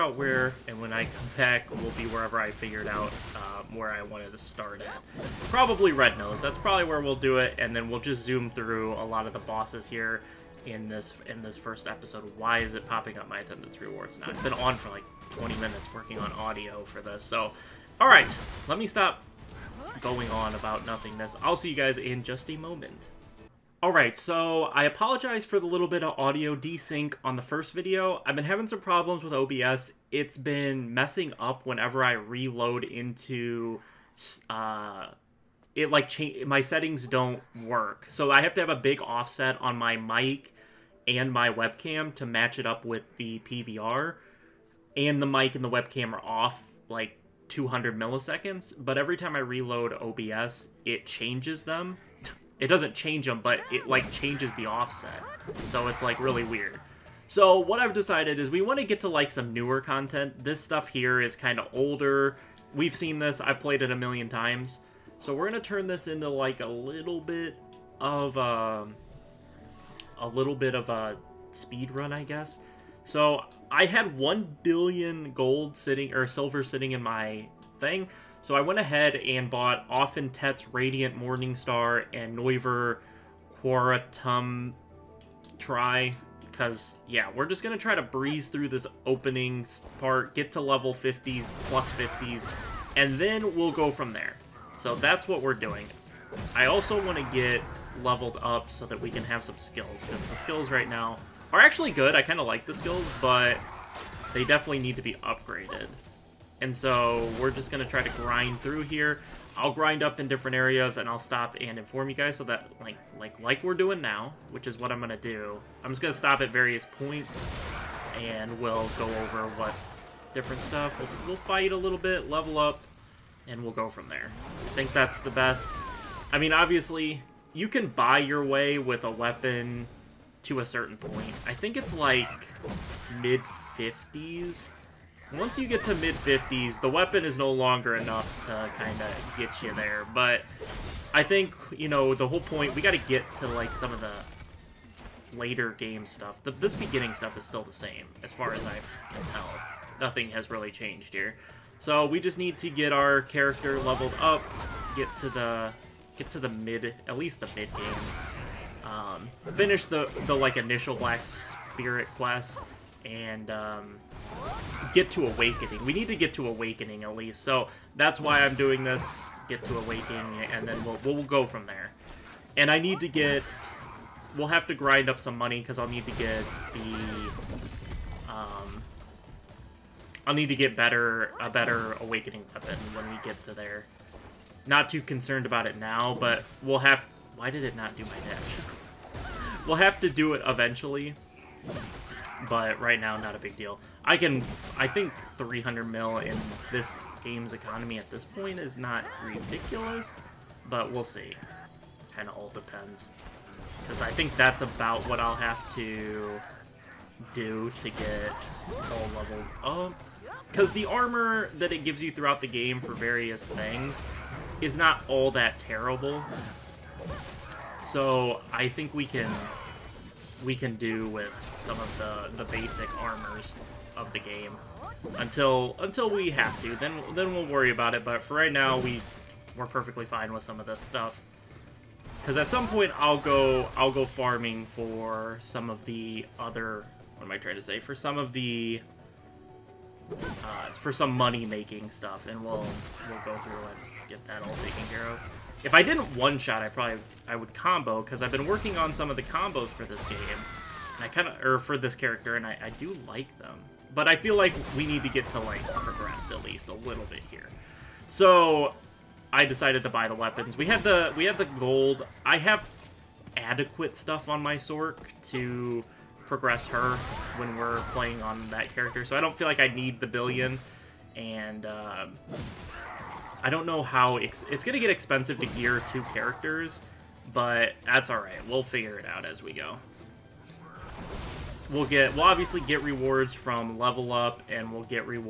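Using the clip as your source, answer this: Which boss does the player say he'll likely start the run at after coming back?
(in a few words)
Red Nose.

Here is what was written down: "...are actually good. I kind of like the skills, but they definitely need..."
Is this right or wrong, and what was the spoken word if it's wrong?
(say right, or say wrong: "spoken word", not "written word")
right.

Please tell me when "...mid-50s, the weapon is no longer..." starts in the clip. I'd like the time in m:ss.
2:15.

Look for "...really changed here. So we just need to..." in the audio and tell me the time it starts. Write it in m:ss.
2:30.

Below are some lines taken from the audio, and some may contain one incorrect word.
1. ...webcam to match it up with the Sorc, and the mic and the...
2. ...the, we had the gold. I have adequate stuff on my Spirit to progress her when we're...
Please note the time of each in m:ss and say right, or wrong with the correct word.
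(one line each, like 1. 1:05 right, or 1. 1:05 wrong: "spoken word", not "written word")
1. 0:41 wrong: "PVR", not "Sorc"
2. 4:20 wrong: "Sorc", not "Spirit".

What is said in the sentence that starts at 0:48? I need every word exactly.
But every time I reload OBS, it changes them.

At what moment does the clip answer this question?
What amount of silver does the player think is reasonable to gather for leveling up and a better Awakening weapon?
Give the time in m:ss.
3:15.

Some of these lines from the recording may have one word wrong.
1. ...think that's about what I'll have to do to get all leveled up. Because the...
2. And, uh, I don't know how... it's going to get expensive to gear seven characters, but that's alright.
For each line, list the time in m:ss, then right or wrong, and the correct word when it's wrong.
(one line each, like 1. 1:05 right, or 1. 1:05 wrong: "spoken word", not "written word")
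1. 3:24 right
2. 4:31 wrong: "two", not "seven".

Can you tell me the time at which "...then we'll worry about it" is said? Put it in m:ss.
3:47.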